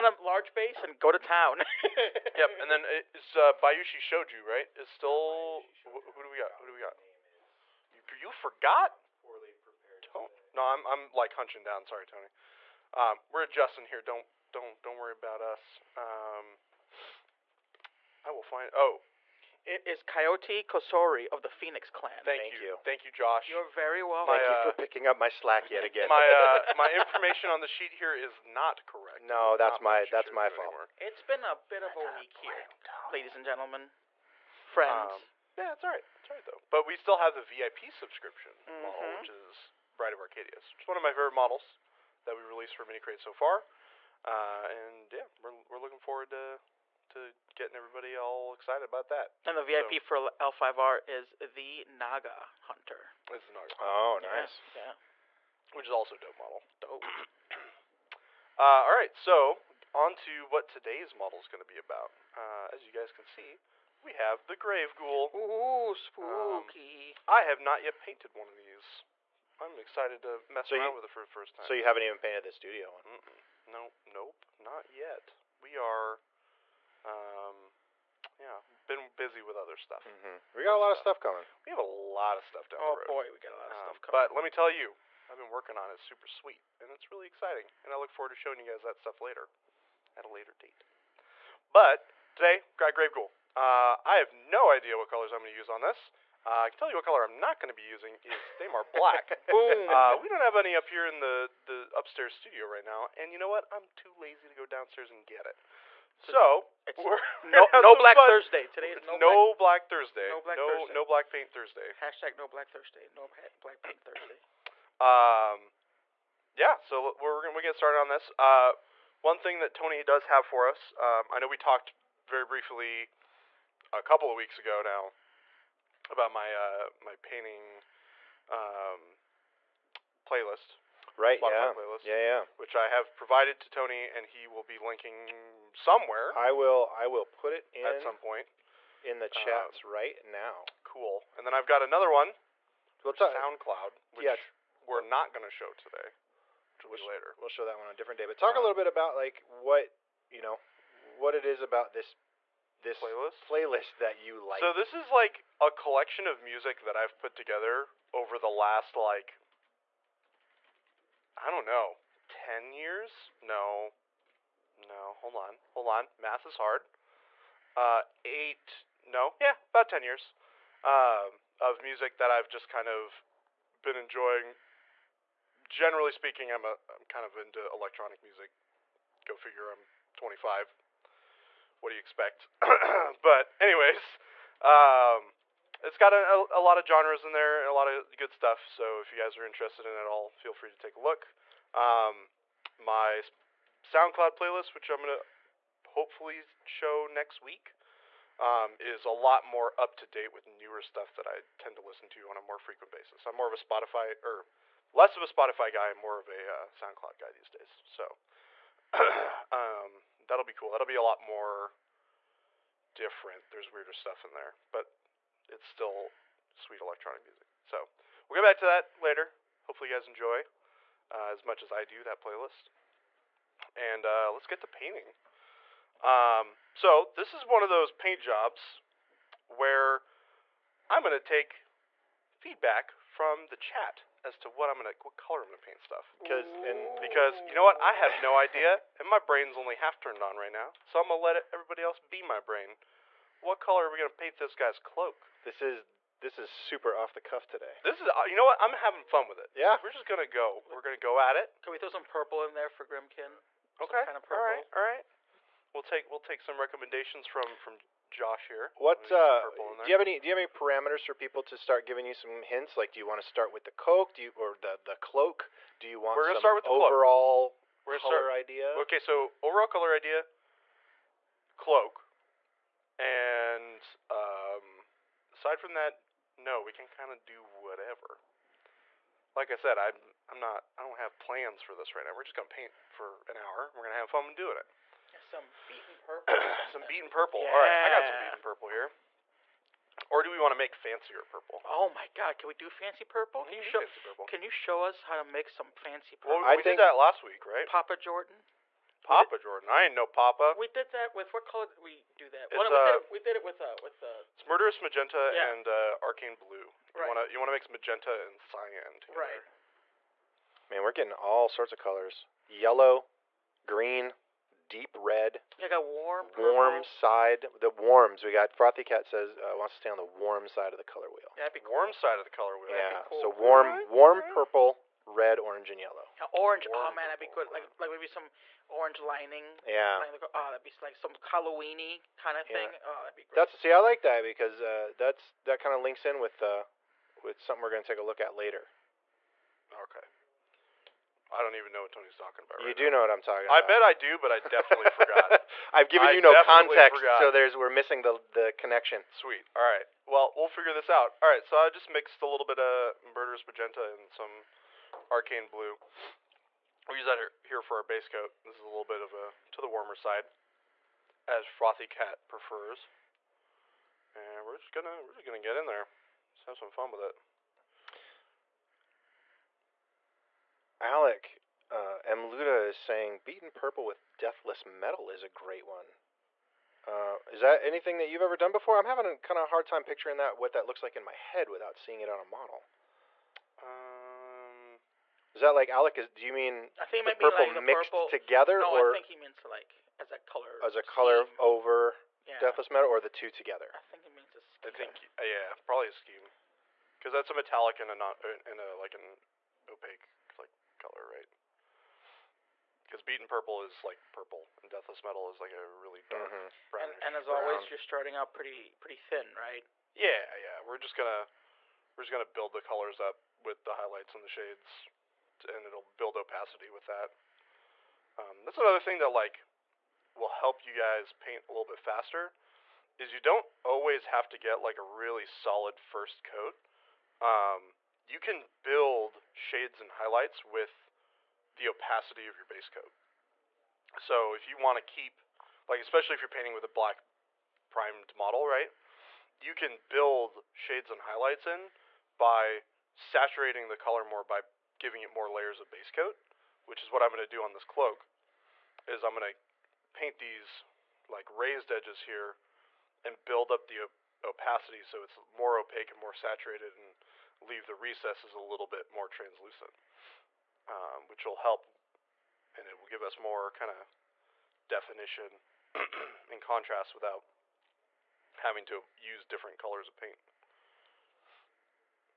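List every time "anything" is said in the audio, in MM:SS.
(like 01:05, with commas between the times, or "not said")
06:17.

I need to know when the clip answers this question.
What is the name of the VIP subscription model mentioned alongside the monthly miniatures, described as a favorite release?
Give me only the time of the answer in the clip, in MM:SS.
00:39.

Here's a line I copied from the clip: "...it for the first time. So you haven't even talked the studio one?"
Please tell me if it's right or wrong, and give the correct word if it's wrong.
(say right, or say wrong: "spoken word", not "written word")
wrong: "painted", not "talked".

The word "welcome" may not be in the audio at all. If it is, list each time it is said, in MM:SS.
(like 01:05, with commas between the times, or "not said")
00:24.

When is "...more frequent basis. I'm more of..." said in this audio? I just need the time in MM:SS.
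03:22.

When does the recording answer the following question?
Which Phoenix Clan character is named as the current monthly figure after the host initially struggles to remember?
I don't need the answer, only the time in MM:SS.
00:20.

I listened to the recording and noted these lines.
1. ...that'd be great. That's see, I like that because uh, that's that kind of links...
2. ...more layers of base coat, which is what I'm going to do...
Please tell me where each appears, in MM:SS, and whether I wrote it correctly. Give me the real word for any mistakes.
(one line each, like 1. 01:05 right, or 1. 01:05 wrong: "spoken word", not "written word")
1. 05:33 right
2. 07:25 right.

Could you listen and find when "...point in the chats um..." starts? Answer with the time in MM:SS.
02:18.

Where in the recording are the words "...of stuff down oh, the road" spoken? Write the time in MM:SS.
01:22.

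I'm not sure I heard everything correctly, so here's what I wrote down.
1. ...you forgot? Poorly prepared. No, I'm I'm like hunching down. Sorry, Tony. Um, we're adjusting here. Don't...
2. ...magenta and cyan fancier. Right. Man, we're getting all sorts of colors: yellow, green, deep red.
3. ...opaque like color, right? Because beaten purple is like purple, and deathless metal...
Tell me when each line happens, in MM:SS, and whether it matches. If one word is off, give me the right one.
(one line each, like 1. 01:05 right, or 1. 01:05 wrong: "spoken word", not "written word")
1. 00:08 right
2. 05:07 wrong: "together", not "fancier"
3. 06:39 right.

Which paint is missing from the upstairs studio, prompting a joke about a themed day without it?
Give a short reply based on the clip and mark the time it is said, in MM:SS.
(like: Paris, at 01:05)
Thamar Black, at 01:38.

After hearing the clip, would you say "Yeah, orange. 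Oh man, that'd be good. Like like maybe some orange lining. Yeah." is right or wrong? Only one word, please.
right.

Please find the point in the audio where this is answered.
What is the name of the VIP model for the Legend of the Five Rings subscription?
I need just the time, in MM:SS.
00:51.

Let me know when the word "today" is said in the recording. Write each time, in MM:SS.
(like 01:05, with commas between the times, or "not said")
01:00, 01:32, 01:48, 02:25, 04:07.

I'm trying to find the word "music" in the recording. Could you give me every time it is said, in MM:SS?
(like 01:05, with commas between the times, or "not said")
02:36, 02:51, 02:58, 03:37.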